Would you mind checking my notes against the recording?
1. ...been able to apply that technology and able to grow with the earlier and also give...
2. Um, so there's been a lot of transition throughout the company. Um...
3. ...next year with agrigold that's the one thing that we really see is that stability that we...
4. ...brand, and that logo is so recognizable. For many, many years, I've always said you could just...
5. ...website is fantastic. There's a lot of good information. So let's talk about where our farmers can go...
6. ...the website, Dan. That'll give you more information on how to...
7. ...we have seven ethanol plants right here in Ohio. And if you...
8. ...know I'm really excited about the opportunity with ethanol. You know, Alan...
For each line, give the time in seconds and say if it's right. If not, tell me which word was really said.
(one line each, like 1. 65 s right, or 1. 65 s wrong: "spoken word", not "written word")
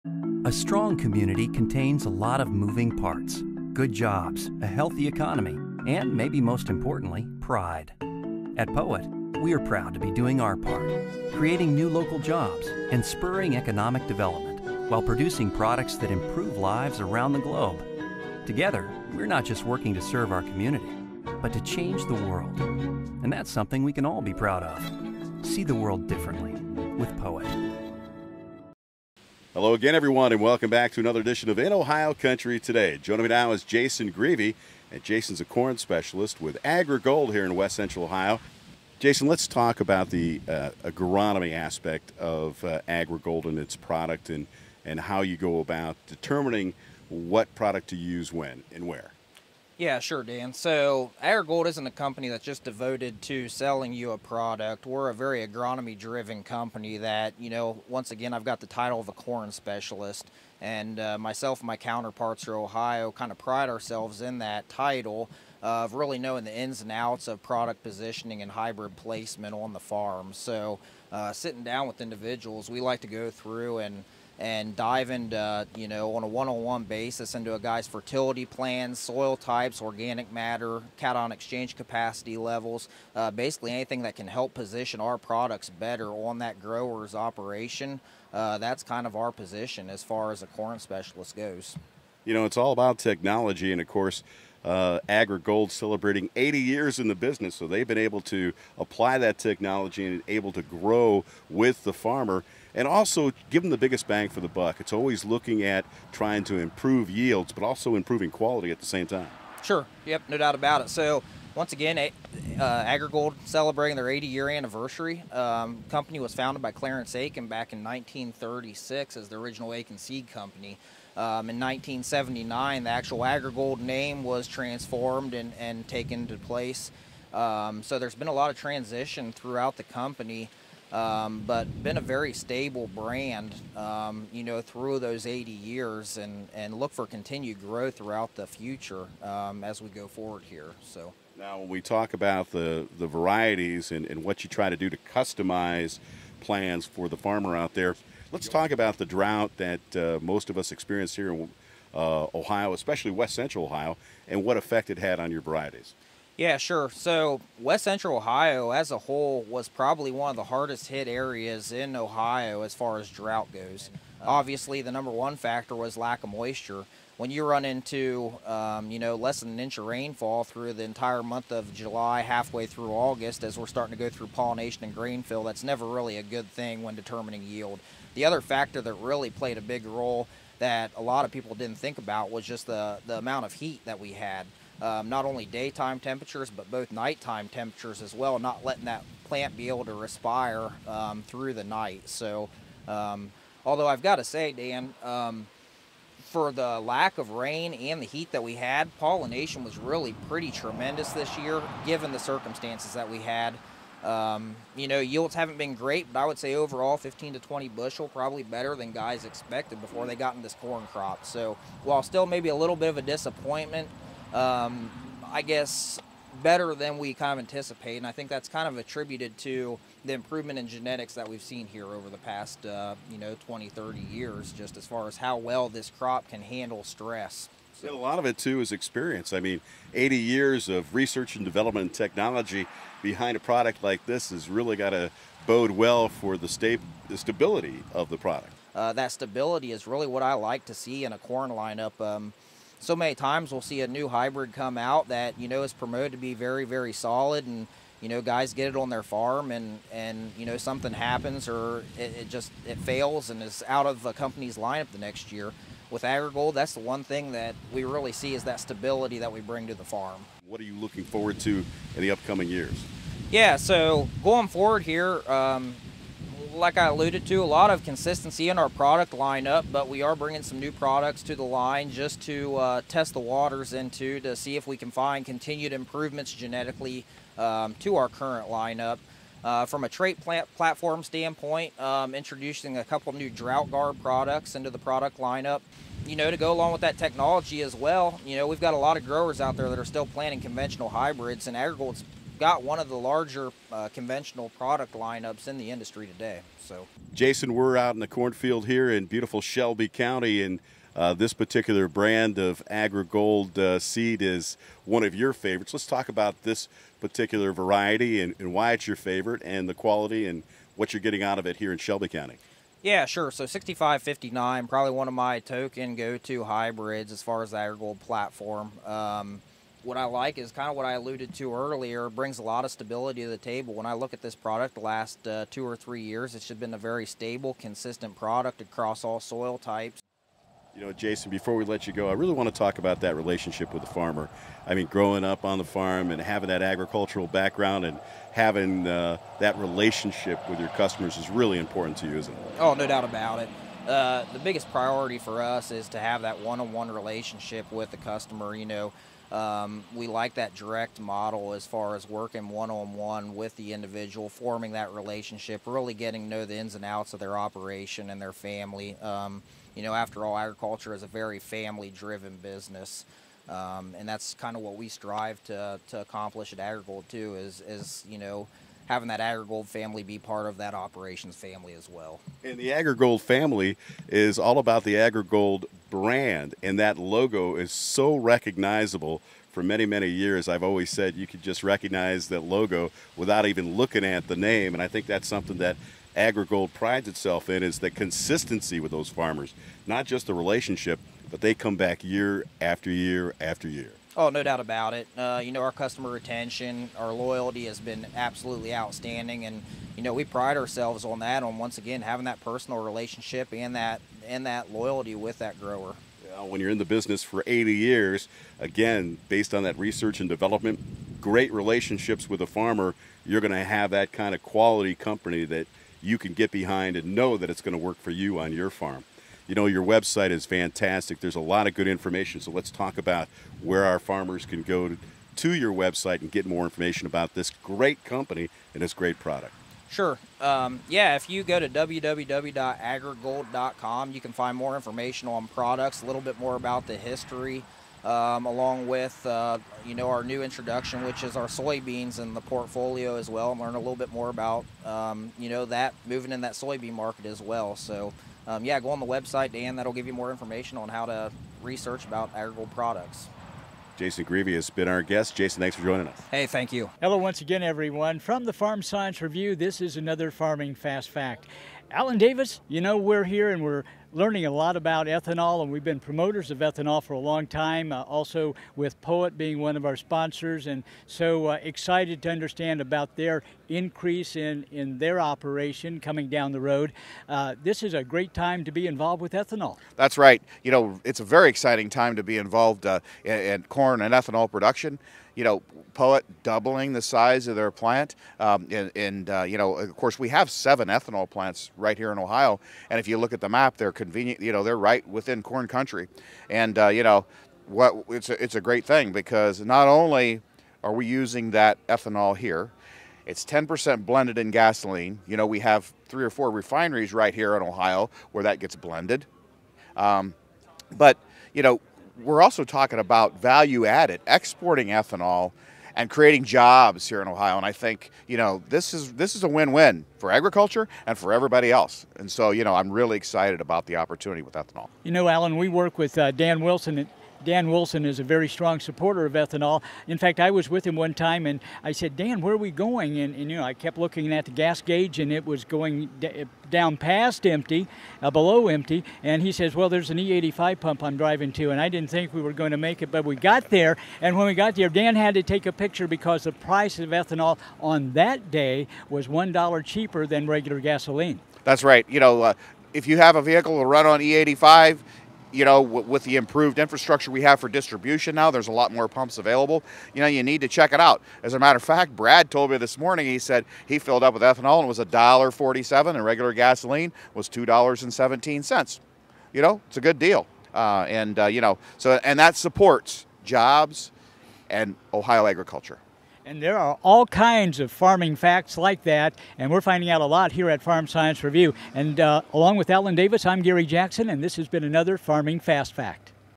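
1. 97 s wrong: "farmer", not "earlier"
2. 127 s right
3. 254 s right
4. 375 s right
5. 419 s right
6. 448 s right
7. 490 s right
8. 522 s right.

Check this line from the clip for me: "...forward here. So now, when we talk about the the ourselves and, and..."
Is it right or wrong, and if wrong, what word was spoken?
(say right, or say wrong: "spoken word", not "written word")
wrong: "varieties", not "ourselves".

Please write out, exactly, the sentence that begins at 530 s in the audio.
In fact, I was with him one time and I said, Dan, where are we going?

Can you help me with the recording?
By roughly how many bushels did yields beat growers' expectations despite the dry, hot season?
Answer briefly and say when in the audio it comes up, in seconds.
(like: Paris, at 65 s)
15 to 20, at 206 s.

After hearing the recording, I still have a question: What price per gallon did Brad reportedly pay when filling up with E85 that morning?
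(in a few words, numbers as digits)
$1.47.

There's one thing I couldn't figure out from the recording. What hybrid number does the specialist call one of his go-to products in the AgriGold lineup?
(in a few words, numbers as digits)
6559.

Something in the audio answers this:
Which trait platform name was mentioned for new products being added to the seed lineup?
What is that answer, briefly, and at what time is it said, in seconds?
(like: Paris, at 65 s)
DroughtGard, at 283 s.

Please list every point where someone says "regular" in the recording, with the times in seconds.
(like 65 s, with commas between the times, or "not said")
550 s, 566 s.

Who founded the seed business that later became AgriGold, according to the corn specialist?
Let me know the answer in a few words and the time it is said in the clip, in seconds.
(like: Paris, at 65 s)
Clarence Aiken, at 116 s.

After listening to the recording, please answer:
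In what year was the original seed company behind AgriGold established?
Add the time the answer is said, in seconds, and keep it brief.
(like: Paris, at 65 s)
1936, at 117 s.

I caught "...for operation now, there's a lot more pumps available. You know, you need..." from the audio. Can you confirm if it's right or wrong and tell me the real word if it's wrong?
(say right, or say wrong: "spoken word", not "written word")
wrong: "distribution", not "operation".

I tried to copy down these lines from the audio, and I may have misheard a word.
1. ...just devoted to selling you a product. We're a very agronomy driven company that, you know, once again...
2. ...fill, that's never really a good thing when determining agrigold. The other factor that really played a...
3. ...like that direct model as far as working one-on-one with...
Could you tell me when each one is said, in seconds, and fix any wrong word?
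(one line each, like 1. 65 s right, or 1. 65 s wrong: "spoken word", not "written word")
1. 52 s right
2. 175 s wrong: "yield", not "agrigold"
3. 350 s right.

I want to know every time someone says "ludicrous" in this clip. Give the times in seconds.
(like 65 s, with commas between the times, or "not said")
not said.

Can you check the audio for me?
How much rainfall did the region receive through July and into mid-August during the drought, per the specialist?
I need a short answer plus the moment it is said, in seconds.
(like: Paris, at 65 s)
less than an inch, at 169 s.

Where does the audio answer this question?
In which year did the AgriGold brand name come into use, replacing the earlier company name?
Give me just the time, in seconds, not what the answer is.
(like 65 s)
121 s.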